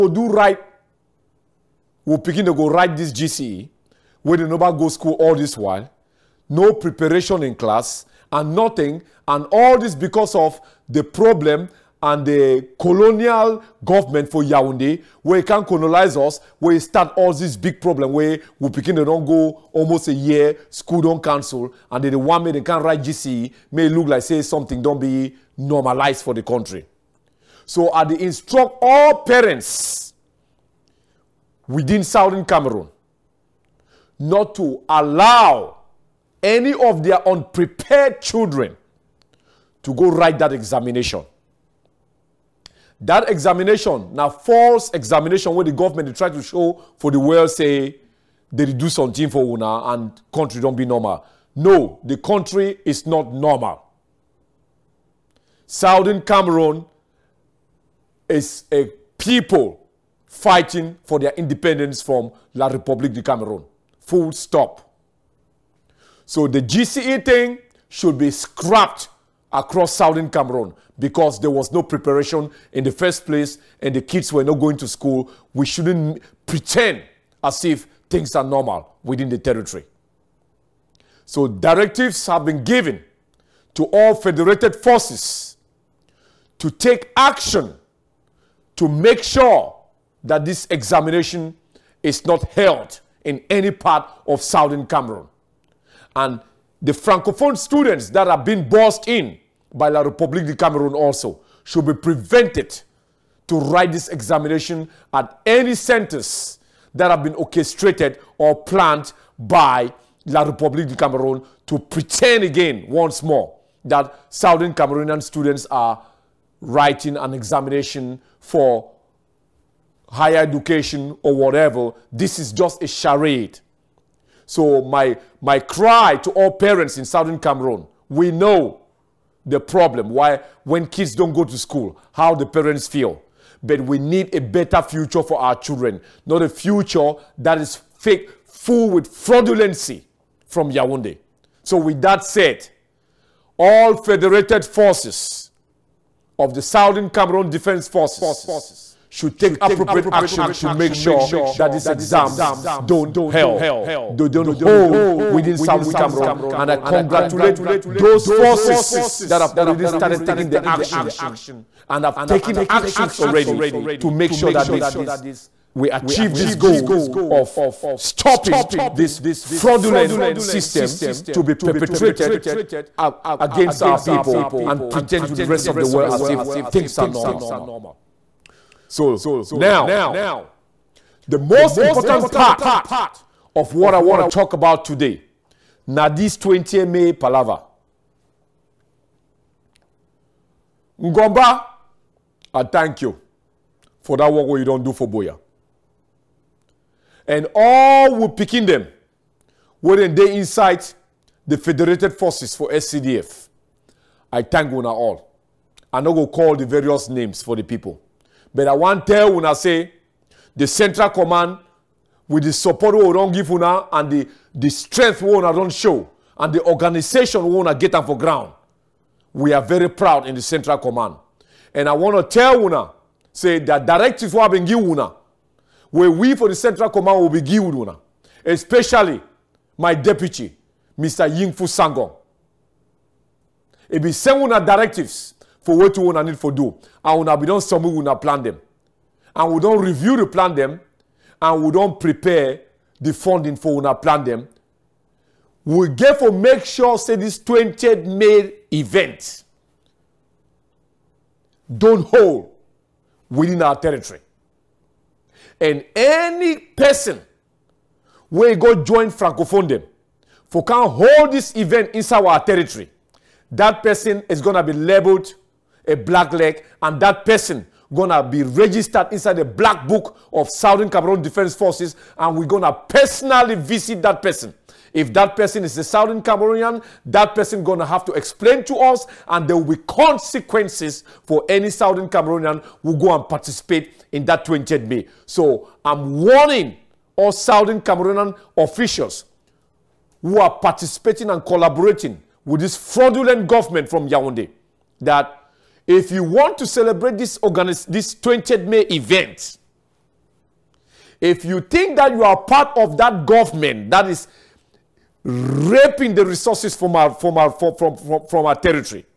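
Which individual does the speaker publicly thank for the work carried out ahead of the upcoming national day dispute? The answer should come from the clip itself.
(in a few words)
Ngomba.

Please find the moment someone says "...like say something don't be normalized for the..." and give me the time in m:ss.
0:24.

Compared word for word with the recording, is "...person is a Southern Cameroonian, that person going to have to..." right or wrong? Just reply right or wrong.
right.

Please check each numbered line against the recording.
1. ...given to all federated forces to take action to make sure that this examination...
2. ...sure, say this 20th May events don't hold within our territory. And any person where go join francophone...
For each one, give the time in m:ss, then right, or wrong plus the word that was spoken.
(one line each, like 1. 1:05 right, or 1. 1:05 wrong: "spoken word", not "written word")
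1. 1:22 right
2. 4:06 right.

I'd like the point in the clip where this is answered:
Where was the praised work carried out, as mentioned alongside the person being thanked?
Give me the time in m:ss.
3:15.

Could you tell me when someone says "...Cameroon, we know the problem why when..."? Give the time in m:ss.
2:07.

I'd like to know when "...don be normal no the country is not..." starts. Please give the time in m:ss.
0:50.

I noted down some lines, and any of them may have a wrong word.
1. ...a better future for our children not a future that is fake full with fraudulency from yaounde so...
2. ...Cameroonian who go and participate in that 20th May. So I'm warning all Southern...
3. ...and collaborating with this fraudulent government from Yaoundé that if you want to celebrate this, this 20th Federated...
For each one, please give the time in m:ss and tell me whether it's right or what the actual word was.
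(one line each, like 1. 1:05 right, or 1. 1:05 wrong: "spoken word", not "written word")
1. 2:14 right
2. 4:42 right
3. 4:51 wrong: "May", not "Federated".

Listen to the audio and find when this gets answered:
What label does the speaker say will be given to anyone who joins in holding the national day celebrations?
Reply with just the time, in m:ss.
4:25.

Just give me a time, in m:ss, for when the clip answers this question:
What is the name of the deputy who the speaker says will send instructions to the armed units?
3:51.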